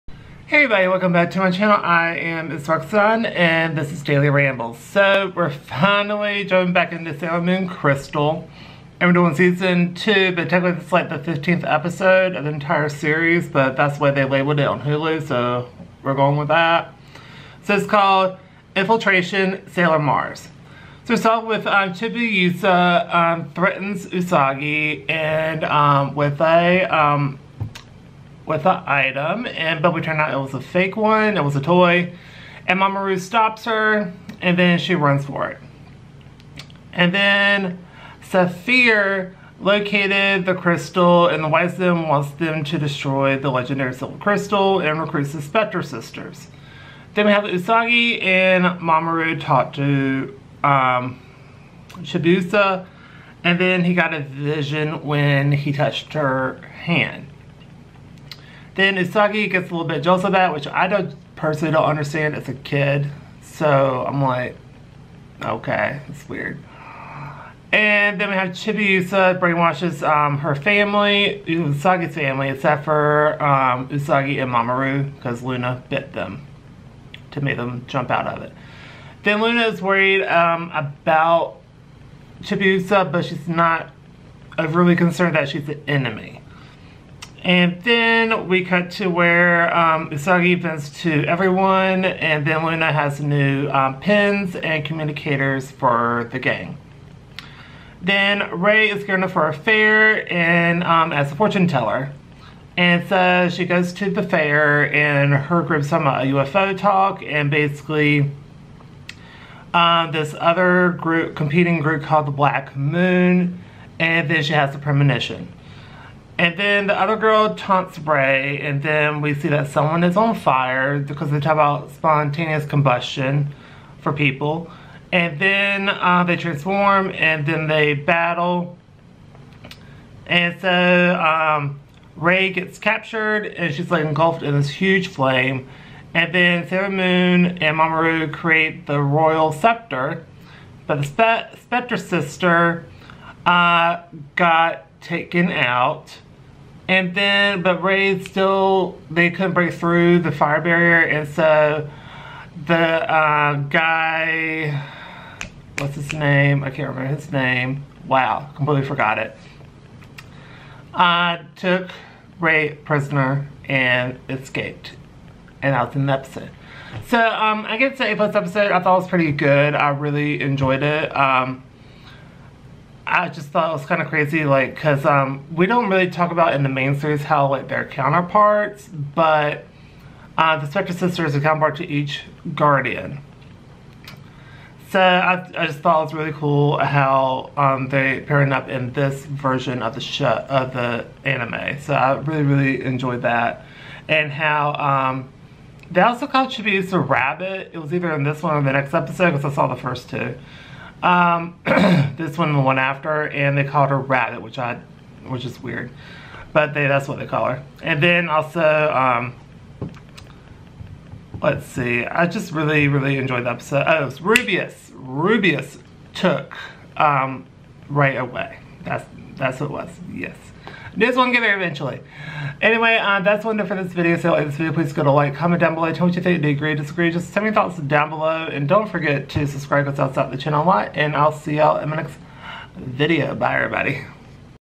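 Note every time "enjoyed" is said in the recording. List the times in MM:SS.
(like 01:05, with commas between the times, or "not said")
02:50, 03:12, 03:33.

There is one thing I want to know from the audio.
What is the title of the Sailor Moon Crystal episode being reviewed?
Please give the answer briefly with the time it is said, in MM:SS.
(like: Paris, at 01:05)
Infiltration Sailor Mars, at 00:18.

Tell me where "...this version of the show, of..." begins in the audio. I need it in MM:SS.
03:08.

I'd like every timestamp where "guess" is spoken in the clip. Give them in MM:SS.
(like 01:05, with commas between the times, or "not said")
02:47.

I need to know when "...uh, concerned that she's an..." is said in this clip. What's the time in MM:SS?
01:24.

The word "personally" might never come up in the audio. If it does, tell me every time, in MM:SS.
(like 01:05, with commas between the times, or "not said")
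01:01.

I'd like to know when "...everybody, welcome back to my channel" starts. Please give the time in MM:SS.
00:00.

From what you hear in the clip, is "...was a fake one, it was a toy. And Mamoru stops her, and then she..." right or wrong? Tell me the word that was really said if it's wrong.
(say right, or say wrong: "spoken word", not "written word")
right.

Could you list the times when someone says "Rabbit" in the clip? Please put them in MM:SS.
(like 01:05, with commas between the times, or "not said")
03:16, 03:23.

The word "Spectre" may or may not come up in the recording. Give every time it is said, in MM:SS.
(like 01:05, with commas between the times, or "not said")
00:45, 02:21, 03:00.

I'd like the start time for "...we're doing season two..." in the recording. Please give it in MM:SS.
00:09.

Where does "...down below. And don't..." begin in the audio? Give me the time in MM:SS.
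03:47.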